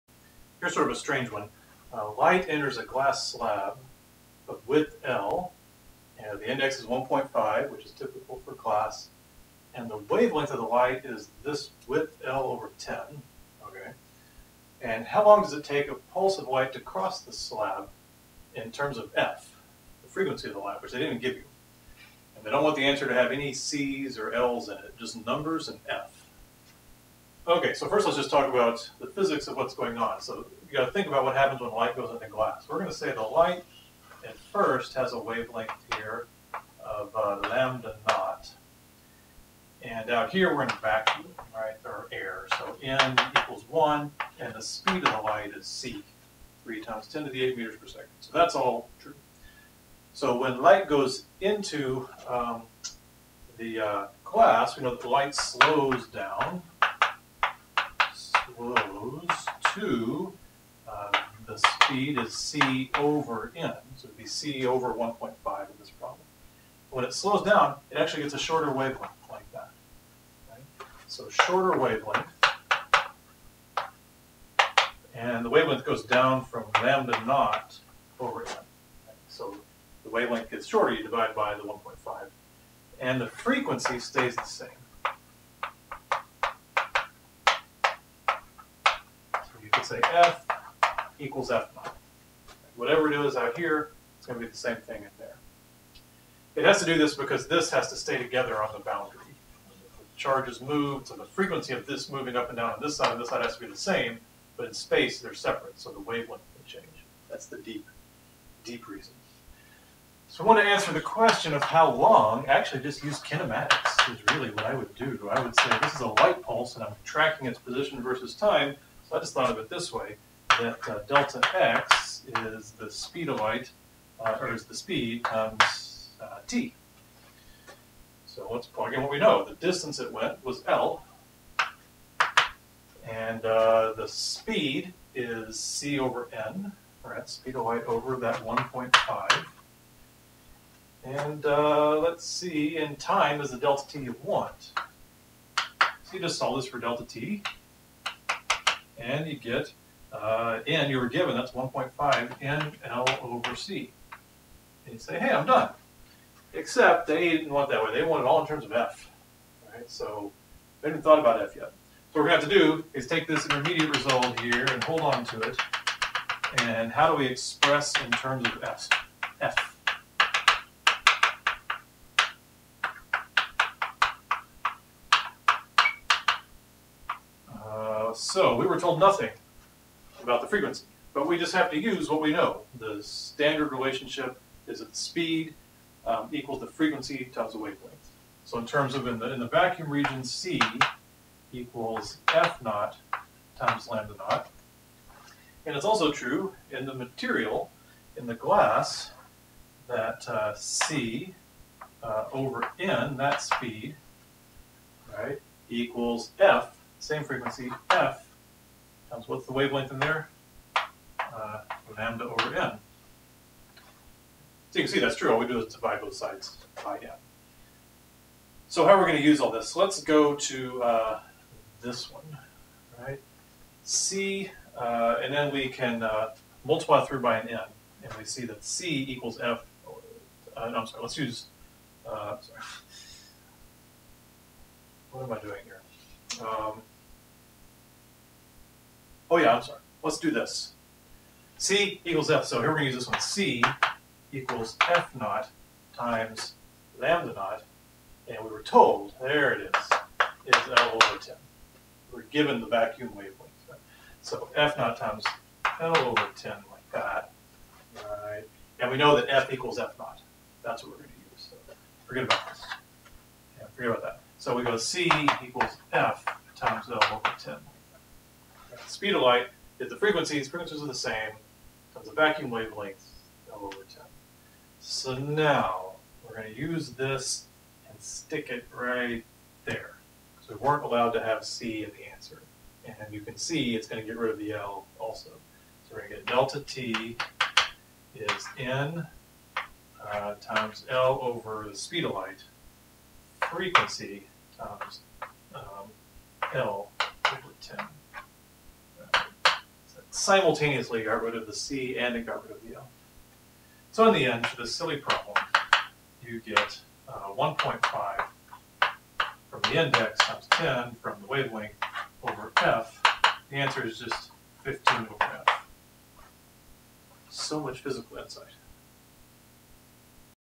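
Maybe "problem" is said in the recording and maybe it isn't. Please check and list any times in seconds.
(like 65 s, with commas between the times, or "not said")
65 s, 304 s.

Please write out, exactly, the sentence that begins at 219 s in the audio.
Let's go to uh, this one, right?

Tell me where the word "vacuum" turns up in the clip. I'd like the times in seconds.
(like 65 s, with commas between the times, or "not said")
40 s, 189 s, 252 s, 272 s.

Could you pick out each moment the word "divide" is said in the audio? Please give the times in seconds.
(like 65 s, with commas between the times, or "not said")
81 s, 215 s.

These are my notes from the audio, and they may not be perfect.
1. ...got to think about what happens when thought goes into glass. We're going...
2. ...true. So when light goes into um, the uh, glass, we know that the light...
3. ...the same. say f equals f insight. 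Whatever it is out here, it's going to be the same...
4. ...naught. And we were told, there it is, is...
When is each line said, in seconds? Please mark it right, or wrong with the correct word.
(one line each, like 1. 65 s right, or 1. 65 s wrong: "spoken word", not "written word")
1. 30 s wrong: "light", not "thought"
2. 48 s right
3. 84 s wrong: "naught", not "insight"
4. 247 s right.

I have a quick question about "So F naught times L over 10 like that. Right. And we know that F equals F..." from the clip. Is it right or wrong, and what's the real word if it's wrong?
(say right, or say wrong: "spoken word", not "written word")
right.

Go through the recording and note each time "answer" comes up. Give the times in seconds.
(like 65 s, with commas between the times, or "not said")
22 s, 110 s, 282 s, 313 s.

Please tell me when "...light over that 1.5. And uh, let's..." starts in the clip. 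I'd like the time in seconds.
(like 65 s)
137 s.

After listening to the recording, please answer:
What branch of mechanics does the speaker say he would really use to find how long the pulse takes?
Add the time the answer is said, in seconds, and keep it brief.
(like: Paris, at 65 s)
kinematics, at 113 s.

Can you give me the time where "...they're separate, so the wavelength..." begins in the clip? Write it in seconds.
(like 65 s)
105 s.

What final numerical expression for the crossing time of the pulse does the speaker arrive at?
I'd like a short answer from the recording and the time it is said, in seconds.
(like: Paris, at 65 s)
15/F, at 314 s.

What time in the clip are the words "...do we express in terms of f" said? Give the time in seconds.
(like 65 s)
167 s.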